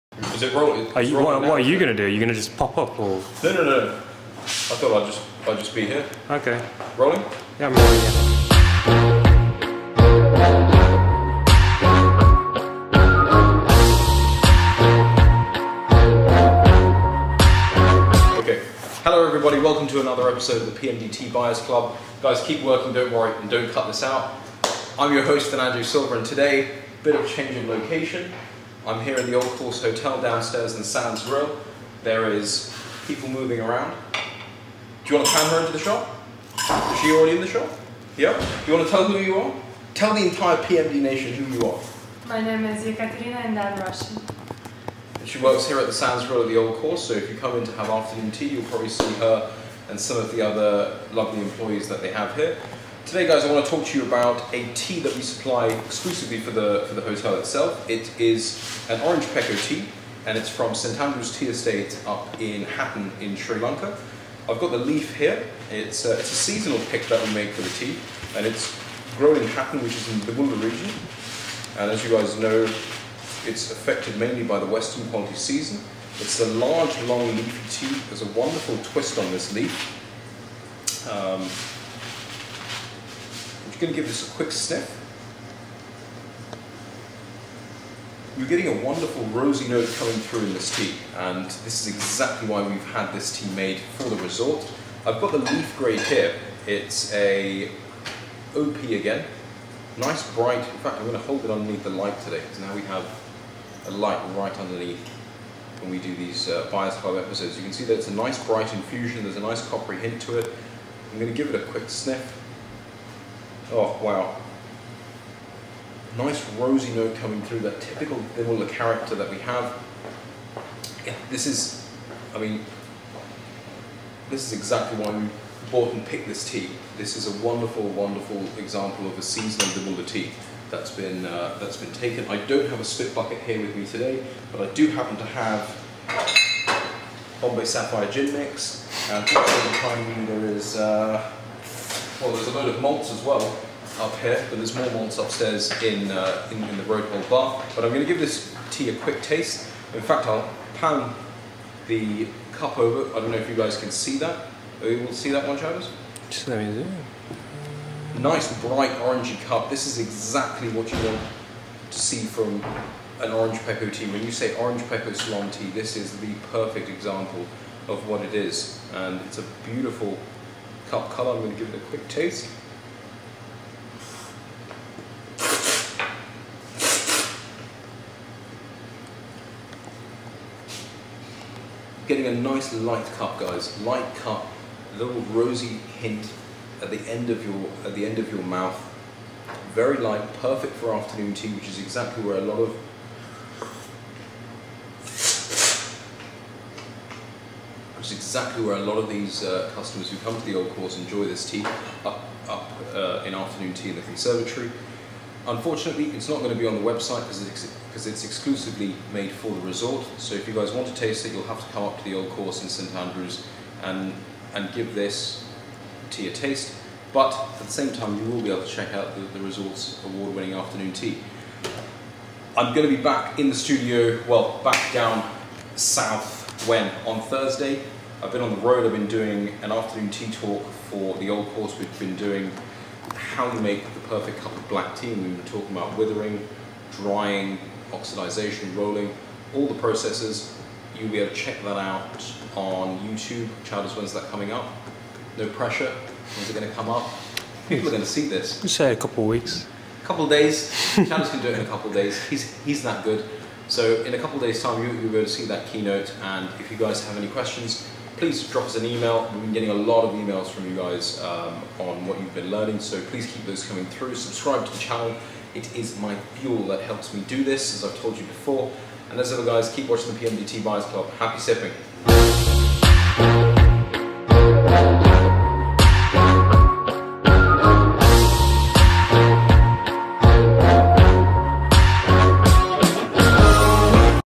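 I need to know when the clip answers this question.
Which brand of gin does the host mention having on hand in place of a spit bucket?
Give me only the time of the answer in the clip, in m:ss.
2:17.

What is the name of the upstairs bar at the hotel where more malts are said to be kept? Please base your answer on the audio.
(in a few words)
Road Hole bar.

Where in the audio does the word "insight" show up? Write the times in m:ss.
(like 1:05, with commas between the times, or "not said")
not said.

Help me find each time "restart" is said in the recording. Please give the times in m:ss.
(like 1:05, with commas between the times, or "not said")
not said.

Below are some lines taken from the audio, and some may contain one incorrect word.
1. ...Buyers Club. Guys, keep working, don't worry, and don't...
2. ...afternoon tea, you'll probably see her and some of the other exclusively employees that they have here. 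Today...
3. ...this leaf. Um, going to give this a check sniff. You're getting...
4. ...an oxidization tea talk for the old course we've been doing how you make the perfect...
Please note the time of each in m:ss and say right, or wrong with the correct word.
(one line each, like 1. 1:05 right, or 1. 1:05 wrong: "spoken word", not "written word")
1. 0:21 right
2. 0:47 wrong: "lovely", not "exclusively"
3. 1:19 wrong: "quick", not "check"
4. 3:49 wrong: "afternoon", not "oxidization".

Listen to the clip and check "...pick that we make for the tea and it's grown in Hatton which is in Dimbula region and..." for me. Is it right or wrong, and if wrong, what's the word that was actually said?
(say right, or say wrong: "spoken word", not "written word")
right.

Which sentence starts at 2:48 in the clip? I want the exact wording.
And it's a beautiful cup color.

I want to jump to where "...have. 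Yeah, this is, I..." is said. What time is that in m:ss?
1:59.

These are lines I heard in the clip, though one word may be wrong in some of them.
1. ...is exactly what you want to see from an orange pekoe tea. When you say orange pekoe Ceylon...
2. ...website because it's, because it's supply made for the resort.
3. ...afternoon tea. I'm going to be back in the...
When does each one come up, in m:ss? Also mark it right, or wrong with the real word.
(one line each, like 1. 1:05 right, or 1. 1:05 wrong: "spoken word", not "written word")
1. 2:39 right
2. 3:26 wrong: "exclusively", not "supply"
3. 3:40 right.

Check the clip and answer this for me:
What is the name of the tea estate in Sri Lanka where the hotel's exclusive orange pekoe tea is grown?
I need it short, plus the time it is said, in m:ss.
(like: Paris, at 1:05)
St Andrew's Tea Estate, at 1:00.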